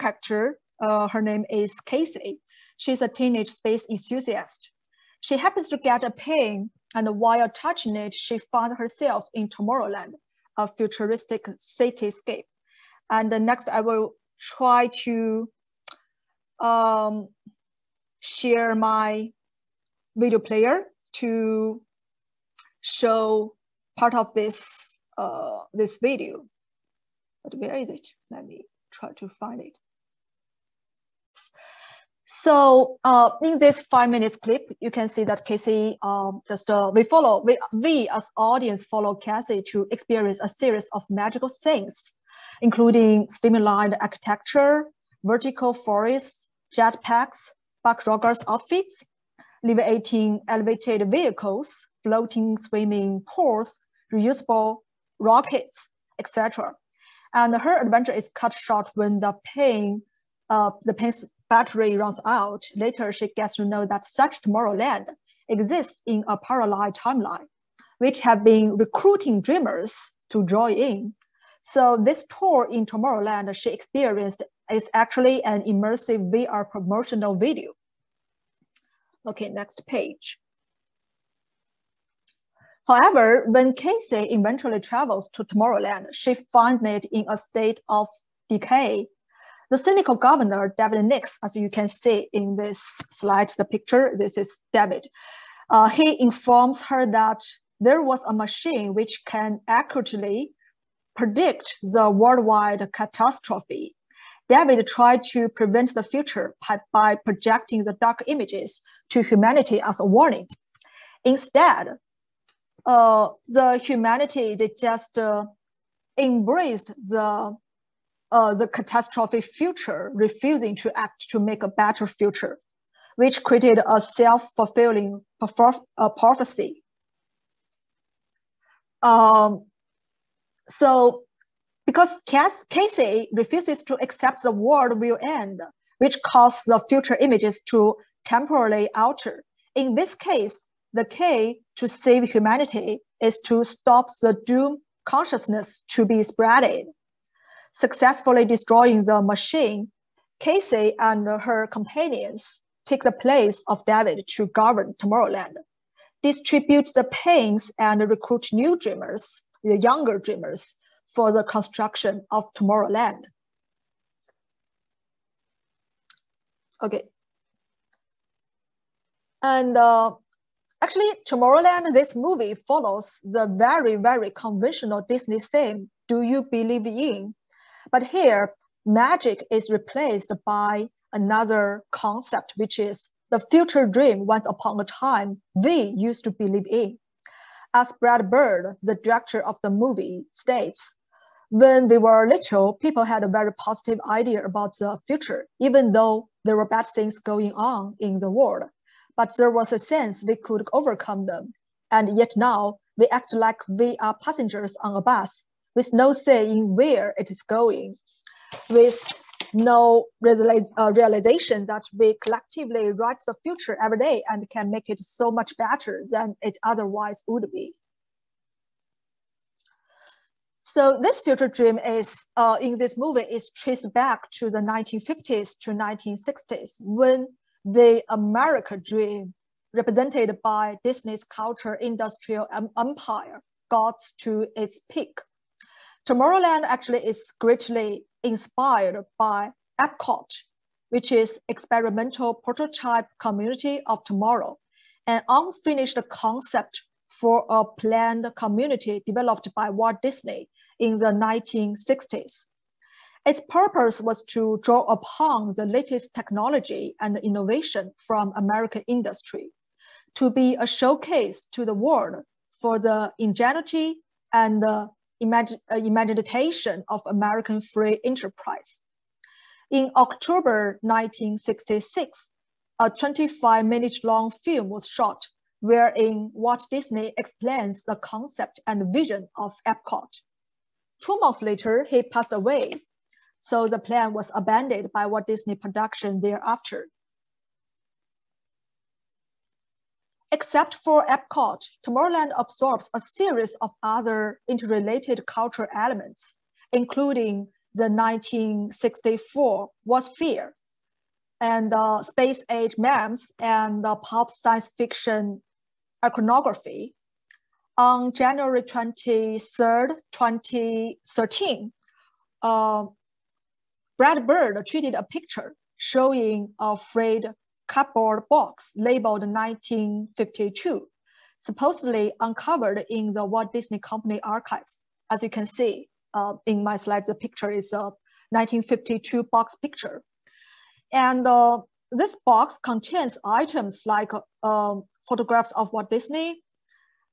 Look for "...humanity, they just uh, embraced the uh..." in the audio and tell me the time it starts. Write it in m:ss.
1:53.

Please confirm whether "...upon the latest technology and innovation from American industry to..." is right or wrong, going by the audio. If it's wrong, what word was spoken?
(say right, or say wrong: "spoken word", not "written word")
right.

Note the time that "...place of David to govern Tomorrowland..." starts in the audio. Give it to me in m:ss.
2:33.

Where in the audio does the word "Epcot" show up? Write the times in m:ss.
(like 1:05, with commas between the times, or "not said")
3:59, 4:39, 4:51.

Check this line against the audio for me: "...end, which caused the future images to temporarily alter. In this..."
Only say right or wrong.
right.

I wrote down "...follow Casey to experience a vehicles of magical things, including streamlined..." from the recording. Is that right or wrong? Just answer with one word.
wrong.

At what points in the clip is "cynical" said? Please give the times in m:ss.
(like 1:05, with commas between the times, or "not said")
1:29.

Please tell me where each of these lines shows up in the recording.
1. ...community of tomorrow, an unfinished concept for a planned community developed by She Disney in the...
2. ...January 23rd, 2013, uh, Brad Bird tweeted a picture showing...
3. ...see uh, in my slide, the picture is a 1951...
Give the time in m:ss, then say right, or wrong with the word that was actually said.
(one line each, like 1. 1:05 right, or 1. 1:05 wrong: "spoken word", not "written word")
1. 4:03 wrong: "Walt", not "She"
2. 5:08 right
3. 5:25 wrong: "1952", not "1951".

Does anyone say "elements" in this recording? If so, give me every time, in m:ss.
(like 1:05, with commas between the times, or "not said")
4:55.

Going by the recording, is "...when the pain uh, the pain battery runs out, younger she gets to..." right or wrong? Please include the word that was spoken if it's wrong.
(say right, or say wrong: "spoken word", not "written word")
wrong: "later", not "younger".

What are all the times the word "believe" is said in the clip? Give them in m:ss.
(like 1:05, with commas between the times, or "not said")
2:56, 3:06.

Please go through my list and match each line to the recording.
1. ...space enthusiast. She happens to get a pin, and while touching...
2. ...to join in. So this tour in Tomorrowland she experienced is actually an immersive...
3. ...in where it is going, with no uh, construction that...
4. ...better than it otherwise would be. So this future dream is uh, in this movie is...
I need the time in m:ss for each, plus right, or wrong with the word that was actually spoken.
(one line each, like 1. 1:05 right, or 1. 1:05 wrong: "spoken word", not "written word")
1. 0:03 right
2. 1:10 right
3. 3:26 wrong: "realization", not "construction"
4. 3:35 right.